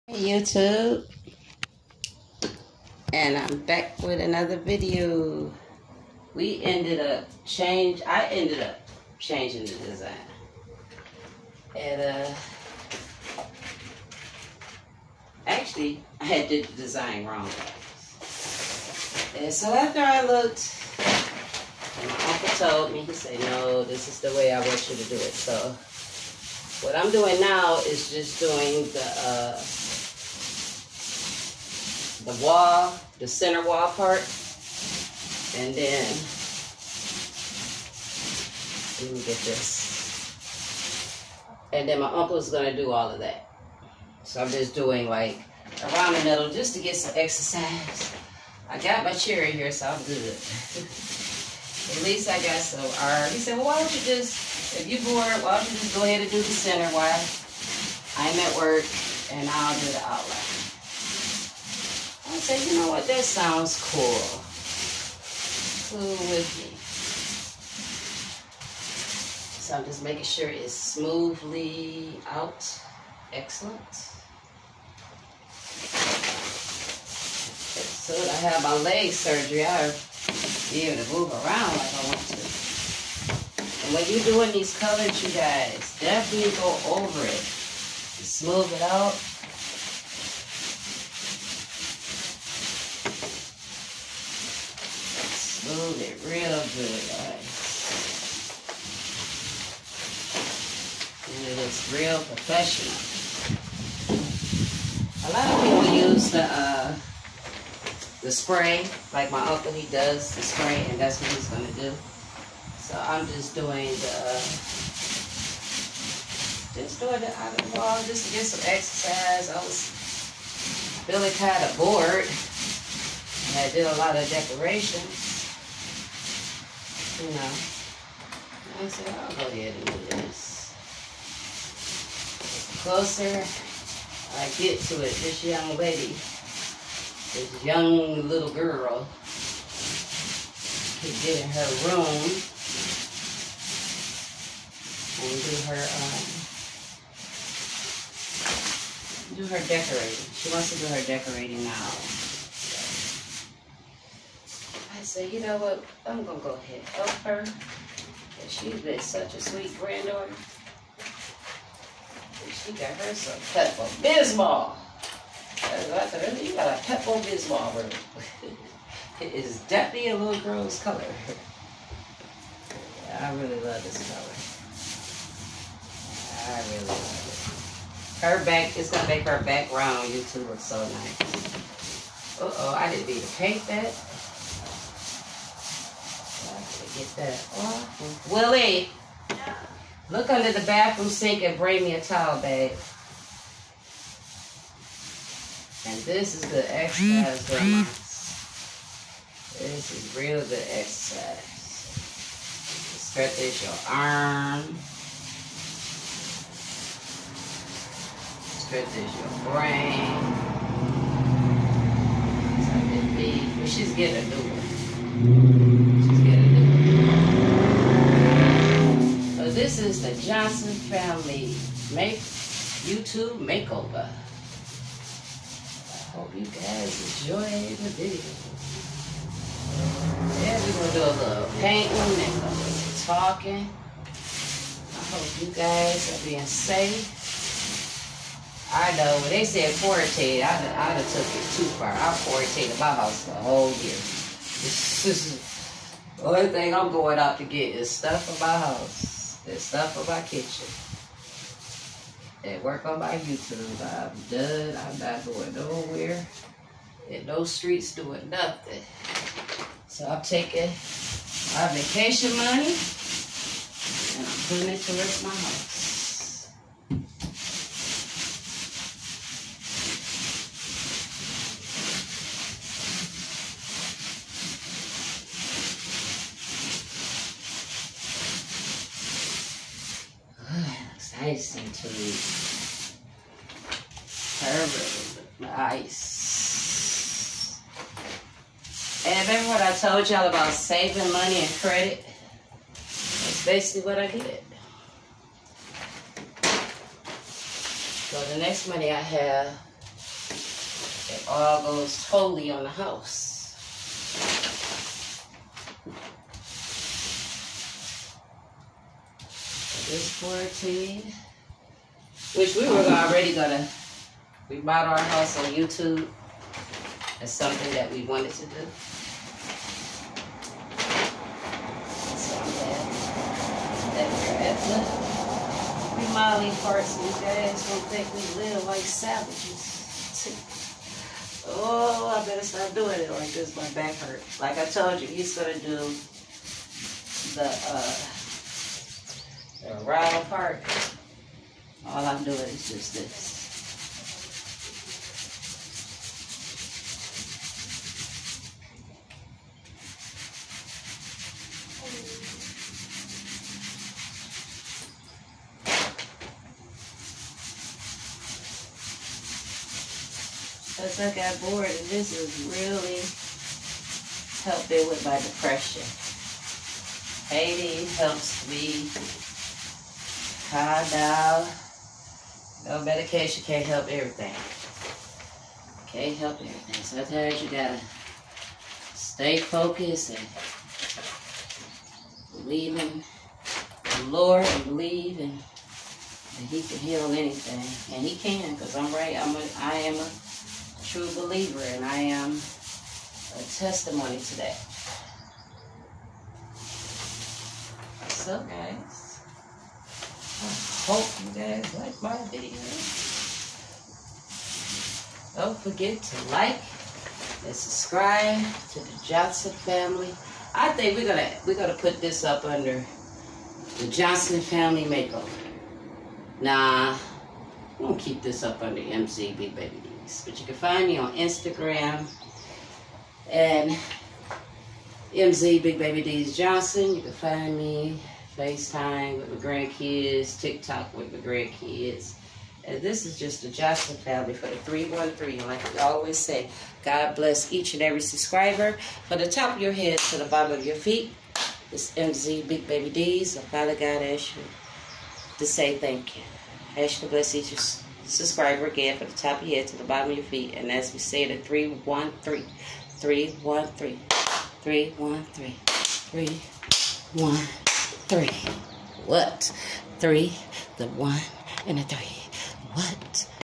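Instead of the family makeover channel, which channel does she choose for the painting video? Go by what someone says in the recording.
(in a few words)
MCB Baby Bees.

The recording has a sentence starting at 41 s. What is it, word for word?
And then my uncle's gonna do all of that.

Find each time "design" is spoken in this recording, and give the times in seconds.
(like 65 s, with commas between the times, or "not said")
9 s, 16 s.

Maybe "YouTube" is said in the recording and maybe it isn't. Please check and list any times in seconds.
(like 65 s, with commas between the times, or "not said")
0 s, 180 s, 222 s, 253 s, 315 s.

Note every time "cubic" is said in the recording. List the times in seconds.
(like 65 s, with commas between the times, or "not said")
not said.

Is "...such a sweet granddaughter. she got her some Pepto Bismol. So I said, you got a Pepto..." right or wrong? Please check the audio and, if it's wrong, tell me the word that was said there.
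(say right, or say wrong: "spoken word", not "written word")
right.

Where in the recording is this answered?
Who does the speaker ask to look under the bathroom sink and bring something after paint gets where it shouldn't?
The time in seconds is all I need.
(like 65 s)
188 s.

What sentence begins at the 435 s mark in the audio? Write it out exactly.
And like we always say, God bless each and every subscriber.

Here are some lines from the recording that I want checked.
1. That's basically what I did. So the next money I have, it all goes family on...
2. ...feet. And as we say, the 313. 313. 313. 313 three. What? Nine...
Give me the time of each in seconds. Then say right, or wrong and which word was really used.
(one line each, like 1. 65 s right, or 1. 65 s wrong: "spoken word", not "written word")
1. 293 s wrong: "totally", not "family"
2. 450 s wrong: "Three", not "Nine".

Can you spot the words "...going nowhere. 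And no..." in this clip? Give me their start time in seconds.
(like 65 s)
255 s.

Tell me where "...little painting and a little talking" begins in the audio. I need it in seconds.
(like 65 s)
231 s.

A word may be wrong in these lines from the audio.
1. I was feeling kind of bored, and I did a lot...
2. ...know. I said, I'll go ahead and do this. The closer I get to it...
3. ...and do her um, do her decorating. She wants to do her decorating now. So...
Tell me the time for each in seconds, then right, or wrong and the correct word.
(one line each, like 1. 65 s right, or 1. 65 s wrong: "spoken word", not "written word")
1. 119 s right
2. 127 s right
3. 145 s right.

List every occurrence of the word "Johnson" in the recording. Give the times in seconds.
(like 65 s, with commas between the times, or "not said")
220 s, 409 s, 413 s, 426 s, 433 s.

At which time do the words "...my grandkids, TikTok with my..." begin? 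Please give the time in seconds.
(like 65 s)
429 s.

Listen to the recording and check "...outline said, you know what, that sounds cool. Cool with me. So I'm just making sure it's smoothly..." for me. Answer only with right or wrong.
right.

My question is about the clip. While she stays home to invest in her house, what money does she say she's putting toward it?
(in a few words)
Vacation money.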